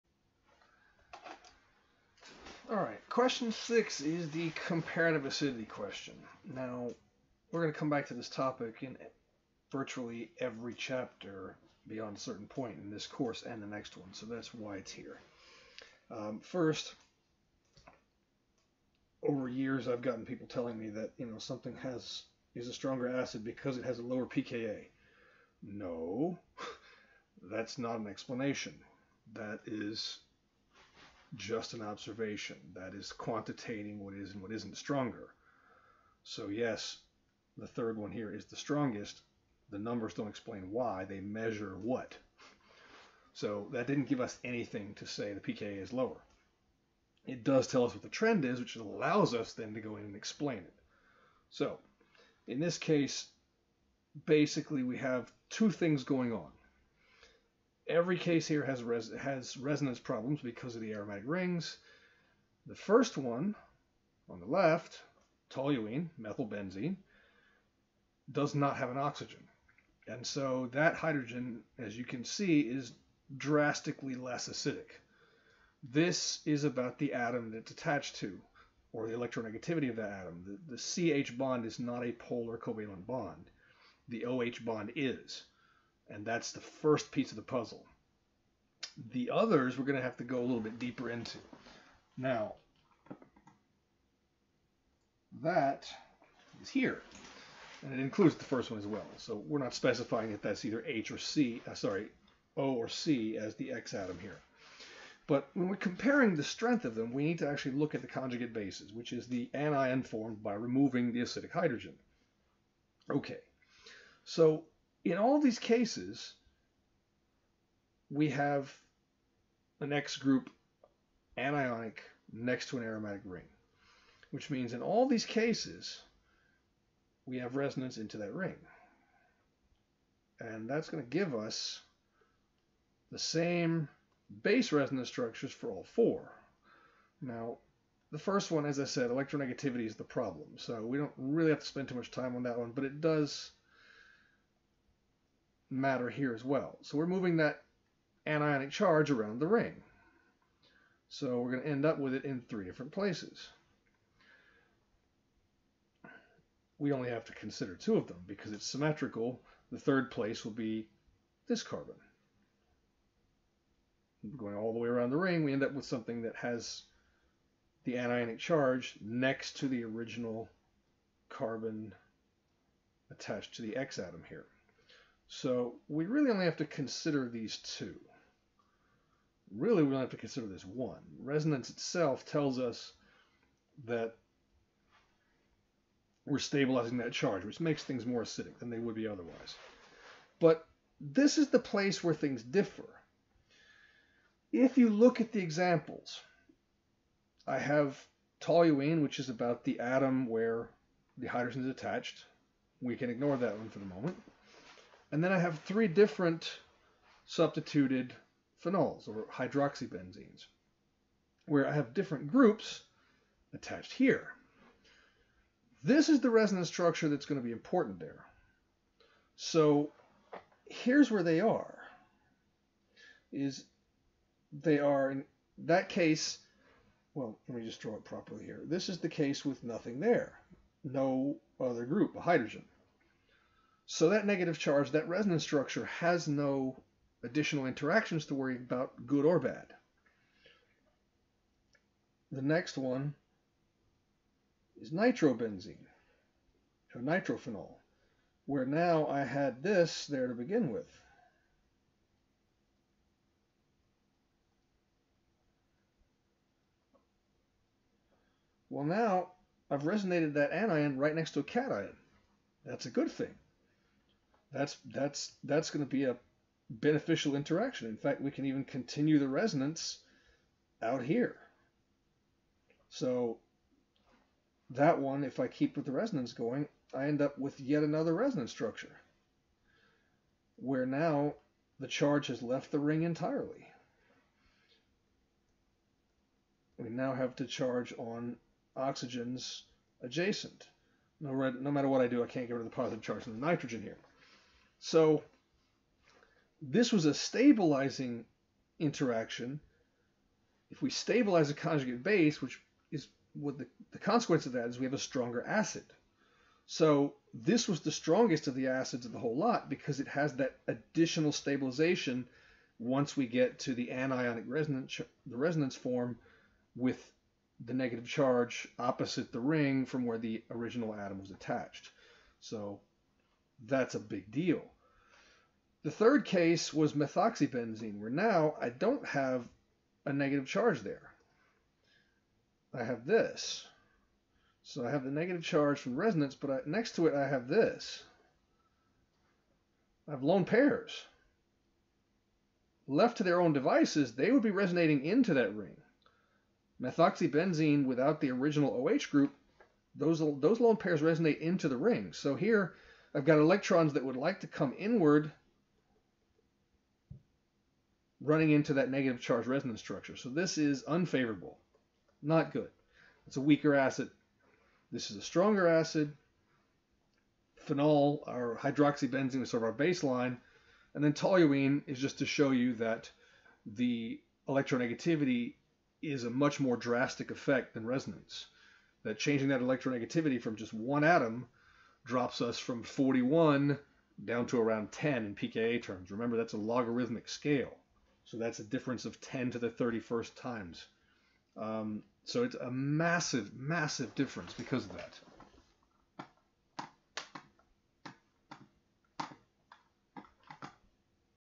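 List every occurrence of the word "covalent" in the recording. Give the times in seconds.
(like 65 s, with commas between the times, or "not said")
82 s.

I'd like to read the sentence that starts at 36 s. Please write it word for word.
So, yes, the third one here is the strongest.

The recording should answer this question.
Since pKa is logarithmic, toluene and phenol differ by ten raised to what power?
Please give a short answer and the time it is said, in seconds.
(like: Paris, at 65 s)
31, at 389 s.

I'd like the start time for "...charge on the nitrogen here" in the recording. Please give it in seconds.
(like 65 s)
293 s.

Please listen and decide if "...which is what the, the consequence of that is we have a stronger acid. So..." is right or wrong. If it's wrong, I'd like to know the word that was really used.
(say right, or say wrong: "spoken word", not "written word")
right.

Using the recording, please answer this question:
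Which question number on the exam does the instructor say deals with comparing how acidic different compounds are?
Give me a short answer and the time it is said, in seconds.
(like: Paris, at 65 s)
6, at 3 s.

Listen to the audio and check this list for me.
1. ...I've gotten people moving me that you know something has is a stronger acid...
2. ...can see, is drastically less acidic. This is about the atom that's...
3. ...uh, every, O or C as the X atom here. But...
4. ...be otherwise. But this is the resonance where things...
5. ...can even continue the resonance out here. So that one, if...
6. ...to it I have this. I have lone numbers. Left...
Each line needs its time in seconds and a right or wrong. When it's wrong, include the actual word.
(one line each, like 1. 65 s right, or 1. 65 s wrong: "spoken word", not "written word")
1. 19 s wrong: "telling", not "moving"
2. 72 s right
3. 101 s wrong: "sorry", not "every"
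4. 188 s wrong: "place", not "resonance"
5. 268 s right
6. 336 s wrong: "pairs", not "numbers".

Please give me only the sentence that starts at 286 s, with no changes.
We now have to charge on oxygens adjacent.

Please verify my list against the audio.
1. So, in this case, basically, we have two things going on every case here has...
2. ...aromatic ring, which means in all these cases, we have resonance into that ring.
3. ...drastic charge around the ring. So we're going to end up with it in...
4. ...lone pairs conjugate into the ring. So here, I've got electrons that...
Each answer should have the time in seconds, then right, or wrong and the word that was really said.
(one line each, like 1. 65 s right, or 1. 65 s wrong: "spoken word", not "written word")
1. 51 s right
2. 122 s right
3. 148 s wrong: "anionic", not "drastic"
4. 350 s wrong: "resonate", not "conjugate".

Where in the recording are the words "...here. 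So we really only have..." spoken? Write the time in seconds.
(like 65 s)
174 s.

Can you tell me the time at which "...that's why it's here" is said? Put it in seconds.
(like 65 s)
14 s.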